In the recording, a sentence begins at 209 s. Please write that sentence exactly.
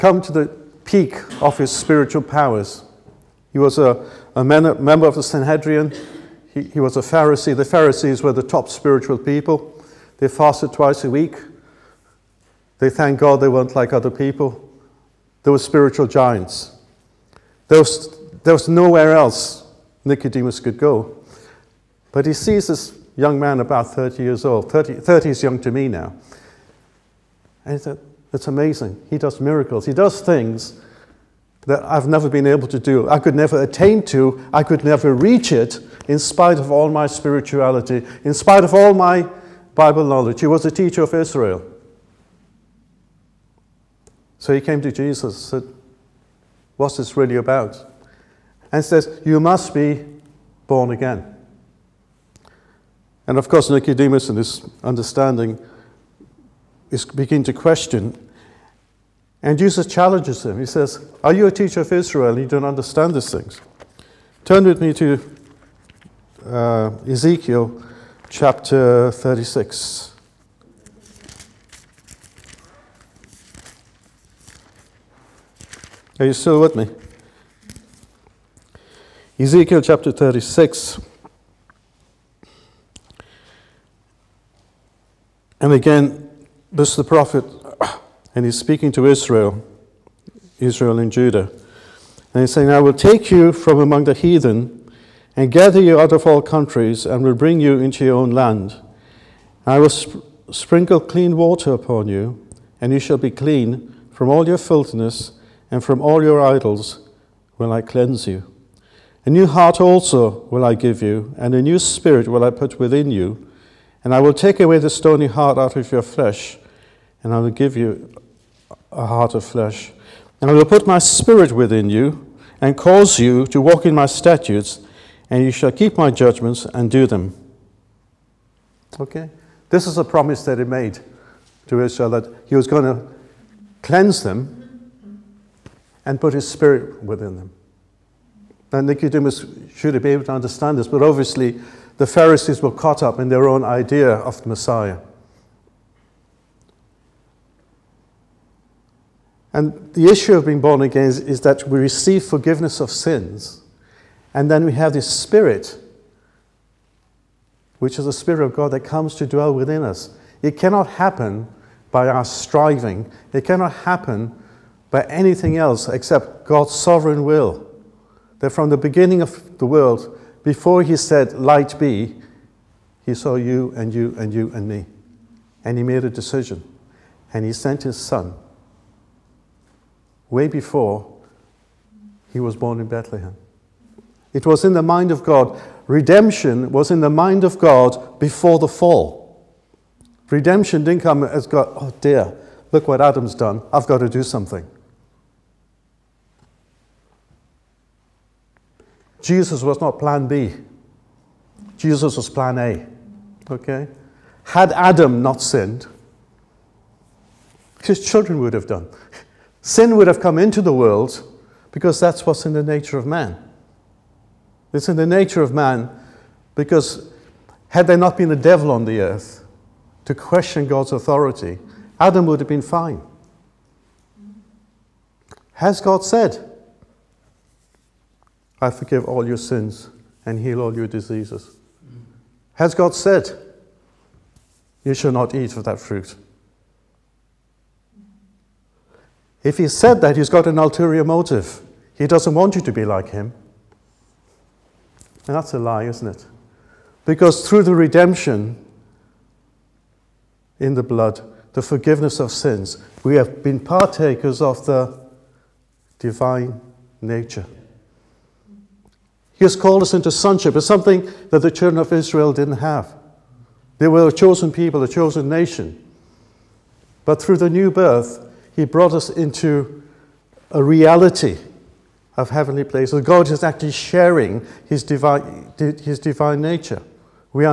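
Sin would have come into the world because that's what's in the nature of man.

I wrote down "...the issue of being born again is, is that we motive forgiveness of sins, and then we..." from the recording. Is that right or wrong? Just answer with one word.
wrong.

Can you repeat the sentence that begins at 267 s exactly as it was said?
But through the new birth, He brought us into a reality of heavenly places.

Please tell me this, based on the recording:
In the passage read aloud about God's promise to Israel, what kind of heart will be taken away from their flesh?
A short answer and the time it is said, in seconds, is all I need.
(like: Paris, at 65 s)
Stony heart, at 114 s.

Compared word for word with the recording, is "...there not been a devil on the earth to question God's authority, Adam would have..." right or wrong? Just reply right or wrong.
right.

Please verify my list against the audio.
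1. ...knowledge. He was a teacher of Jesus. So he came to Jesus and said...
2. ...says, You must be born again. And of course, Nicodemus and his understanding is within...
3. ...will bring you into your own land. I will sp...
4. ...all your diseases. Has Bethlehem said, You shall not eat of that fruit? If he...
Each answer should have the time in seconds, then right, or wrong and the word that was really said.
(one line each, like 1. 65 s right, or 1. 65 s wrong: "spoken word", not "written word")
1. 40 s wrong: "Israel", not "Jesus"
2. 48 s wrong: "begin", not "within"
3. 97 s right
4. 230 s wrong: "God", not "Bethlehem".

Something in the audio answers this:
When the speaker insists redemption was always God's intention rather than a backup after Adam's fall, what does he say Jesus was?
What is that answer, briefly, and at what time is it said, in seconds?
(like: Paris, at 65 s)
Plan A, at 202 s.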